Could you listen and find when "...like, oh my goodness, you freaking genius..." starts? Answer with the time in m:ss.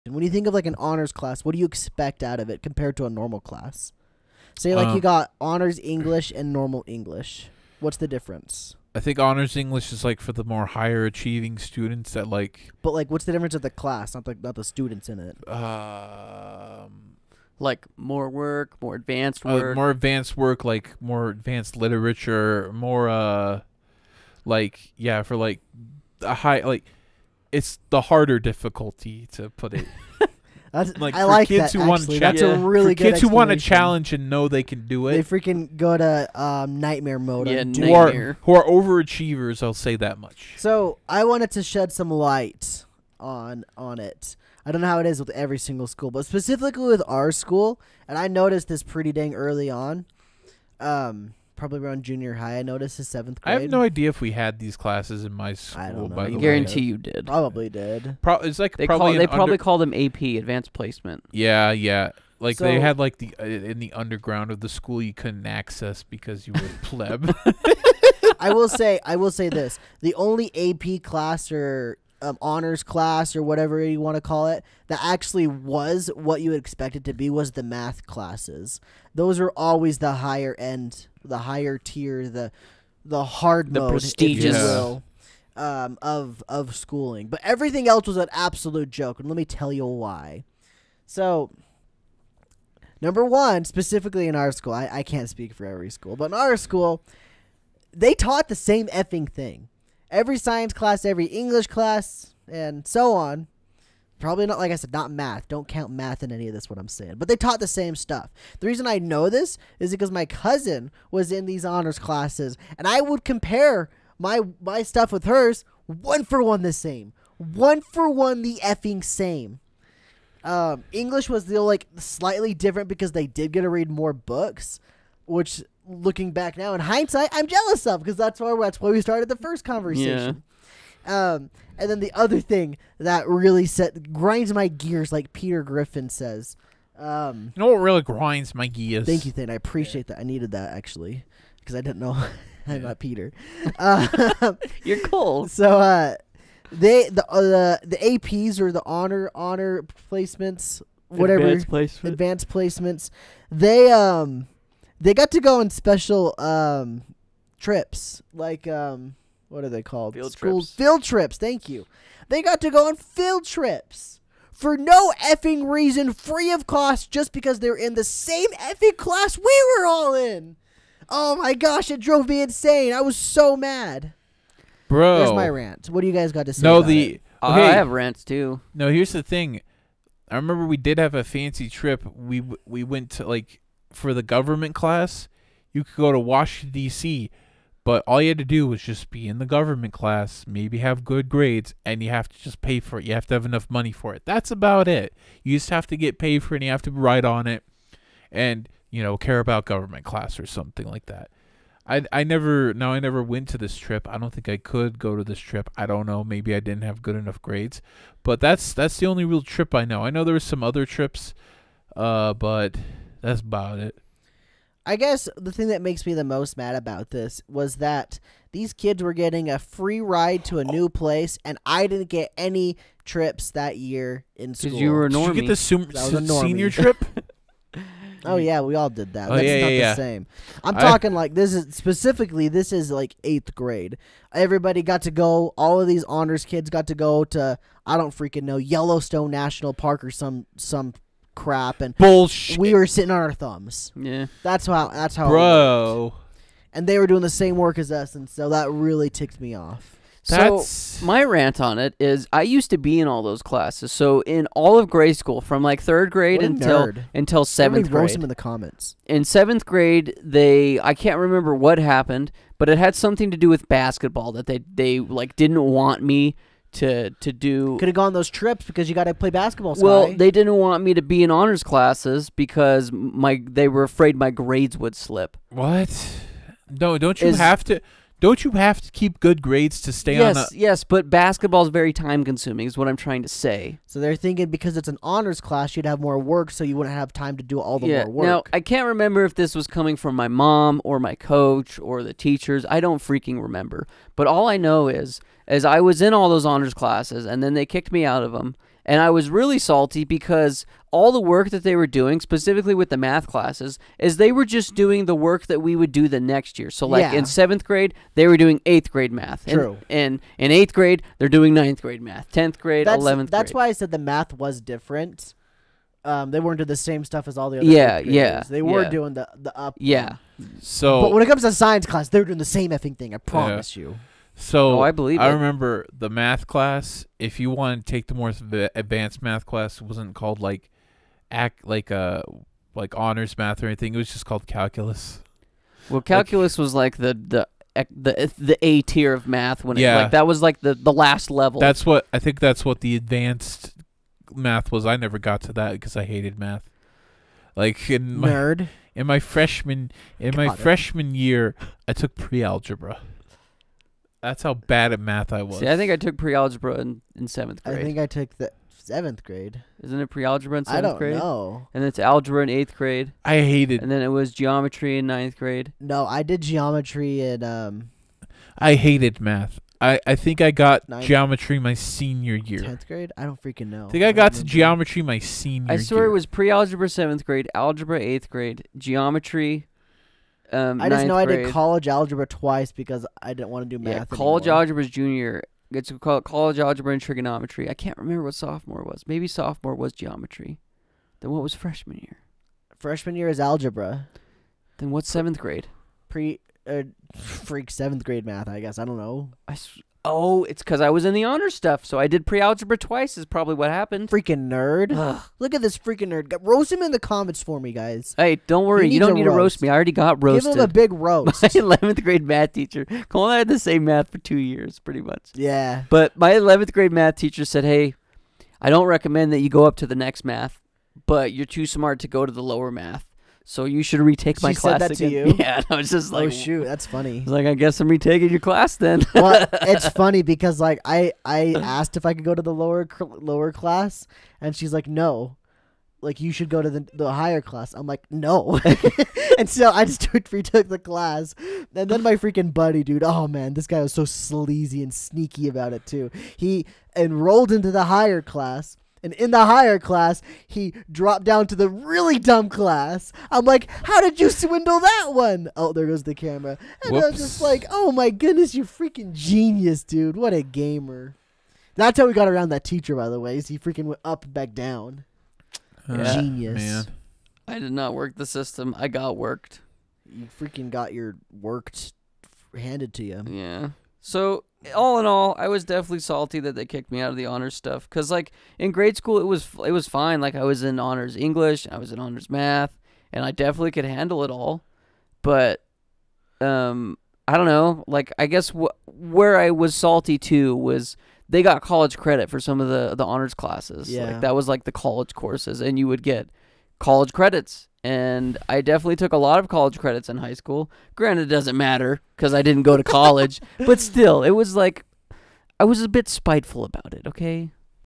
7:37.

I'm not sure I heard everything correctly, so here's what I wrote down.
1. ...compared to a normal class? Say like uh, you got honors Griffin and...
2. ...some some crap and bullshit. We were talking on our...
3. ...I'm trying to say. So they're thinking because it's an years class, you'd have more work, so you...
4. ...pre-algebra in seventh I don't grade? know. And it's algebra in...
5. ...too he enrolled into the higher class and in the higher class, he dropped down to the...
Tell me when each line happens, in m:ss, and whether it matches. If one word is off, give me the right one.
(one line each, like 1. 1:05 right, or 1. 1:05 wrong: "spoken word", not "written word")
1. 0:02 wrong: "English", not "Griffin"
2. 4:00 wrong: "sitting", not "talking"
3. 4:42 wrong: "honors", not "years"
4. 6:00 right
5. 7:25 right.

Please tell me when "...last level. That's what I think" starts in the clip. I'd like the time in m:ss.
5:40.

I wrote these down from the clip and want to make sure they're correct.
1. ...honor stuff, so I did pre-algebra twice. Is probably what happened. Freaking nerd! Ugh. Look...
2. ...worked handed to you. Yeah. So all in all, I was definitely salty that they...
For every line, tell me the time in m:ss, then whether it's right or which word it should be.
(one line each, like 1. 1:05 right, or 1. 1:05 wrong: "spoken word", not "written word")
1. 6:41 right
2. 7:51 right.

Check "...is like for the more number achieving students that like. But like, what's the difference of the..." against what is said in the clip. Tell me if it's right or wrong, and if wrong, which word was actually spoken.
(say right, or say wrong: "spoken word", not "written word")
wrong: "higher", not "number".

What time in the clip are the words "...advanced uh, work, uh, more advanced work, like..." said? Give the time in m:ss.
0:18.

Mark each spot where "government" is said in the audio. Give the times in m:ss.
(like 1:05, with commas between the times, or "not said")
3:04, 3:09, 3:19.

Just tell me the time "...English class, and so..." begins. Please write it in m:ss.
1:41.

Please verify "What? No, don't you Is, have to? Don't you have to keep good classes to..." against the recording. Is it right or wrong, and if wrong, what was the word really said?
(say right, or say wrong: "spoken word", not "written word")
wrong: "grades", not "classes".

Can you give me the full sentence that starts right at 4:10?
So my rant on it is I used to be in all those classes.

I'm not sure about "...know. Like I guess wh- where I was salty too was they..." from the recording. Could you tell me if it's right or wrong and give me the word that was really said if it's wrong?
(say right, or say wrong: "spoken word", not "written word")
right.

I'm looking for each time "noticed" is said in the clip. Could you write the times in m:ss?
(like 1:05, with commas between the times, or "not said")
0:48, 0:52.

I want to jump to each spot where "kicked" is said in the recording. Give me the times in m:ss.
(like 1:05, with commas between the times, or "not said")
4:57, 7:56.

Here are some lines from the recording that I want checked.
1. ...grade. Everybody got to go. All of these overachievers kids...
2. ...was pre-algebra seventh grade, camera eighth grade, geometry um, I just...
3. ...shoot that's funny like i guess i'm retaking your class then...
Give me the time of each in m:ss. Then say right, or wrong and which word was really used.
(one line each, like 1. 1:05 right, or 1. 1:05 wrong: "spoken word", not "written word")
1. 3:53 wrong: "honors", not "overachievers"
2. 6:16 wrong: "algebra", not "camera"
3. 7:06 right.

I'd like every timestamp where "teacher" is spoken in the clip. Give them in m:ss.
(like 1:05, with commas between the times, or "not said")
4:52, 6:52, 6:57, 7:42.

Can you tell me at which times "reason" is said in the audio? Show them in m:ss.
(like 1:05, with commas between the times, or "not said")
1:48, 2:45.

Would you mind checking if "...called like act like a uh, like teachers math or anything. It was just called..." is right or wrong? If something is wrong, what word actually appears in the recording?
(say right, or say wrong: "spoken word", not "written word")
wrong: "honors", not "teachers".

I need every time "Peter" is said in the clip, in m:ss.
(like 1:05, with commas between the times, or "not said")
2:15, 2:22.